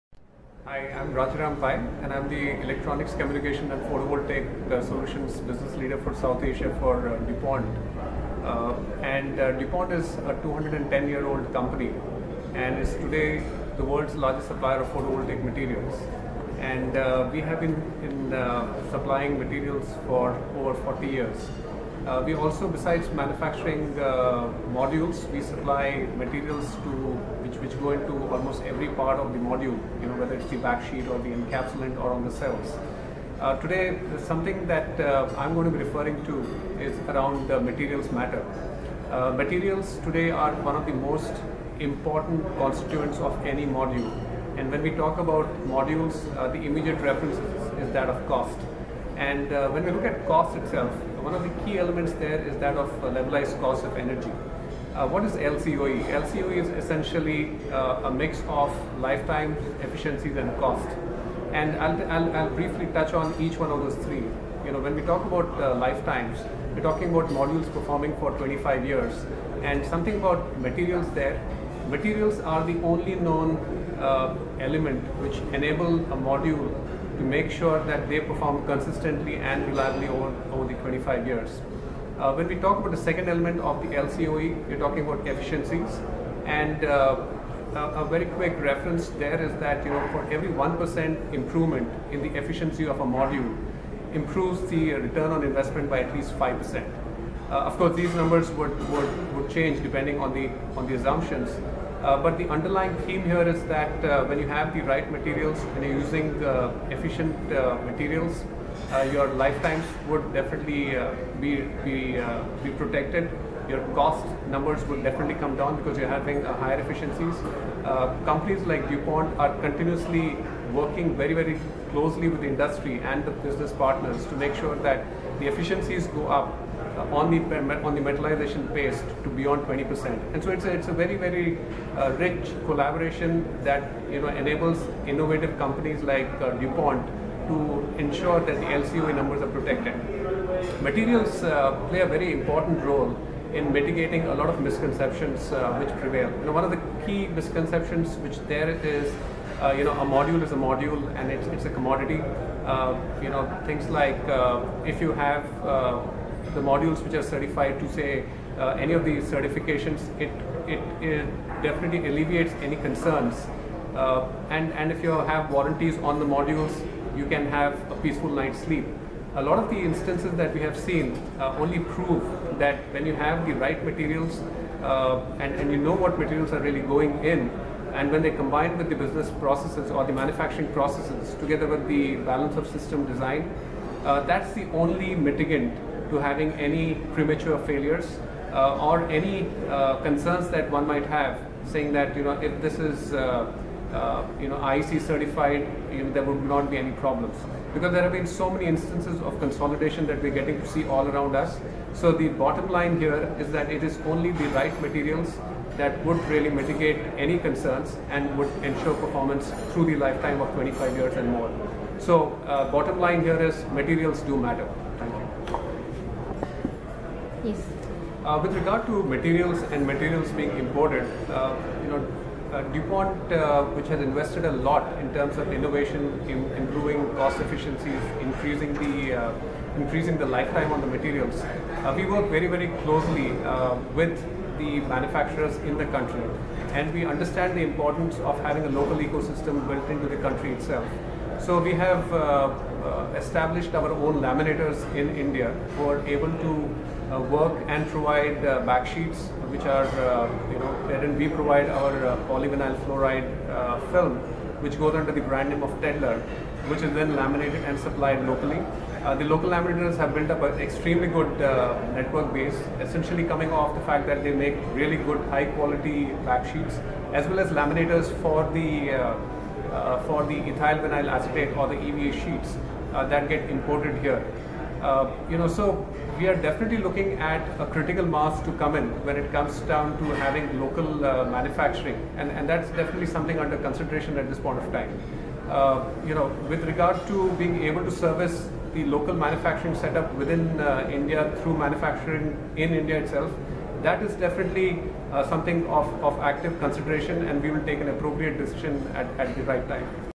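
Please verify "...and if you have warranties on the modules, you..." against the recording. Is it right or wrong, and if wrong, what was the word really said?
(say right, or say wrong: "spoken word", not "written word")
right.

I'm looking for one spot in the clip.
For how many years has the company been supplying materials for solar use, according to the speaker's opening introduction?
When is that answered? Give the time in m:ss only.
0:20.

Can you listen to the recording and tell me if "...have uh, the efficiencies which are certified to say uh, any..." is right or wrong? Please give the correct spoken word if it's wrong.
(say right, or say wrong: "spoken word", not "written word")
wrong: "modules", not "efficiencies".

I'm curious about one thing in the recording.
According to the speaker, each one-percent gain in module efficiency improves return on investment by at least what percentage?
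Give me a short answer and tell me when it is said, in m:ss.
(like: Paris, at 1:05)
5%, at 1:36.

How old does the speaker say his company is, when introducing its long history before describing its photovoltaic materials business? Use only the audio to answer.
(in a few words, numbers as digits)
210 years.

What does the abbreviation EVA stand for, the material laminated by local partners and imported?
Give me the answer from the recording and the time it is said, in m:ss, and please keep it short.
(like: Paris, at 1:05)
Ethyl vinyl acetate, at 4:30.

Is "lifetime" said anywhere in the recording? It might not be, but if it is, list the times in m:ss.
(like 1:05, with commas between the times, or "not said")
0:58, 1:05, 1:49, 3:29, 3:50.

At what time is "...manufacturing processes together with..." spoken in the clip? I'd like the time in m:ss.
3:00.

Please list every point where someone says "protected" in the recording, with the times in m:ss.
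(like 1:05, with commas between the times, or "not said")
1:52, 2:19.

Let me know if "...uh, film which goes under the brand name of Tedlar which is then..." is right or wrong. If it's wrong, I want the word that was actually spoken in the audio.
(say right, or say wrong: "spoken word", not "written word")
right.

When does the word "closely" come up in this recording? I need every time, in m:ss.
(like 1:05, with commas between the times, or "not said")
2:01, 3:52.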